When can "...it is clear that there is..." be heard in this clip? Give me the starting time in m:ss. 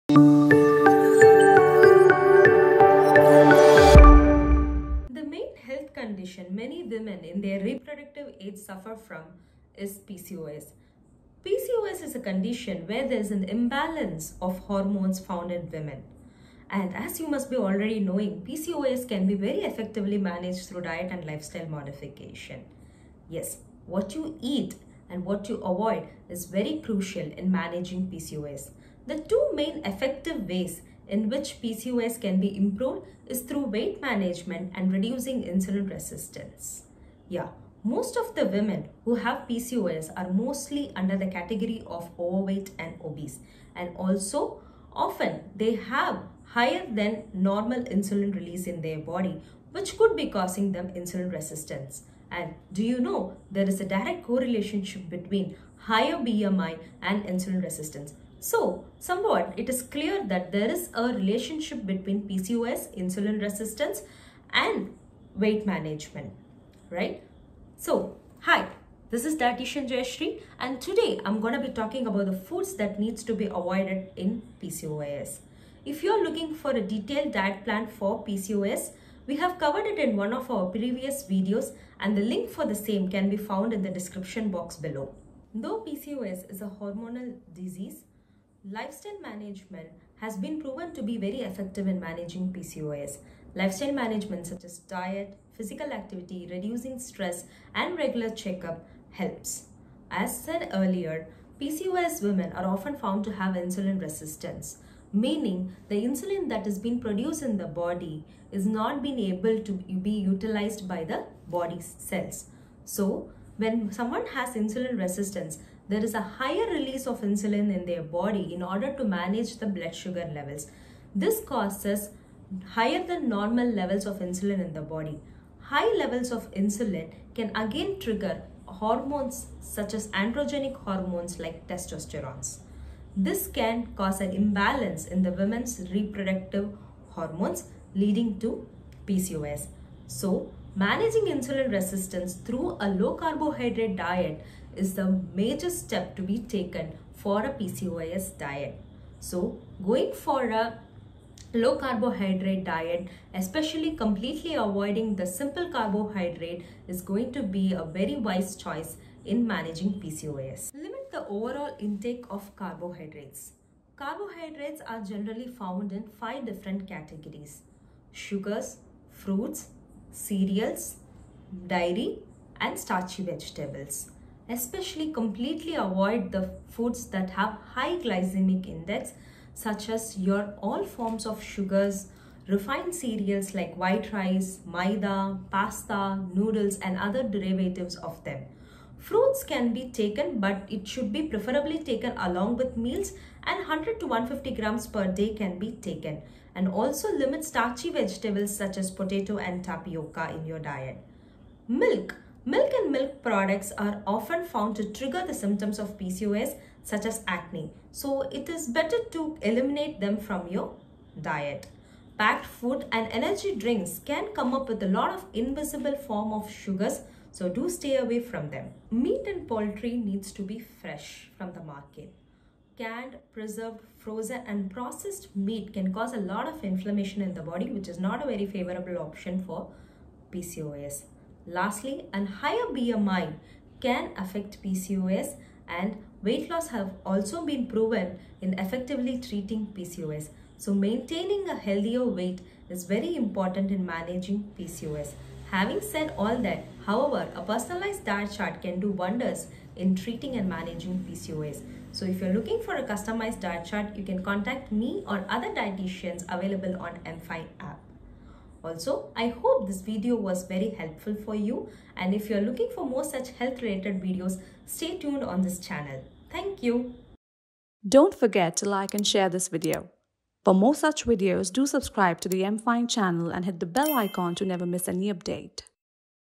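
0:59.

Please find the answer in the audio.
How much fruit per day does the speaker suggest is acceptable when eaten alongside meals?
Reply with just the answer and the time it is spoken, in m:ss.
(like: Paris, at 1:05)
100 to 150 grams, at 3:13.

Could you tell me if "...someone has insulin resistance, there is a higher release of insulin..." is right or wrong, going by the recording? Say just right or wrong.
right.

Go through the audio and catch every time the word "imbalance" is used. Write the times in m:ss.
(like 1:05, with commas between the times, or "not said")
0:13, 2:14.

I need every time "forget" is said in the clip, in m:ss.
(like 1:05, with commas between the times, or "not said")
4:28.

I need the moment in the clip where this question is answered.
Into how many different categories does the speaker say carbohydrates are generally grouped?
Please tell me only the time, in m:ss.
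2:46.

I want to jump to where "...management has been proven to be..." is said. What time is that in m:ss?
1:29.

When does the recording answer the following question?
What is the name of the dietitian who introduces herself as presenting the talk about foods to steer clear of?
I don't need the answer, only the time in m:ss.
1:09.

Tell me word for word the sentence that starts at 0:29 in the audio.
The two main effective ways in which PCOS can be improved is through weight management and reducing insulin resistance.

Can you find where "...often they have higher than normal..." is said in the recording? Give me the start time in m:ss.
0:44.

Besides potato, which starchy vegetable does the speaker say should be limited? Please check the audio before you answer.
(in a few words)
tapioca.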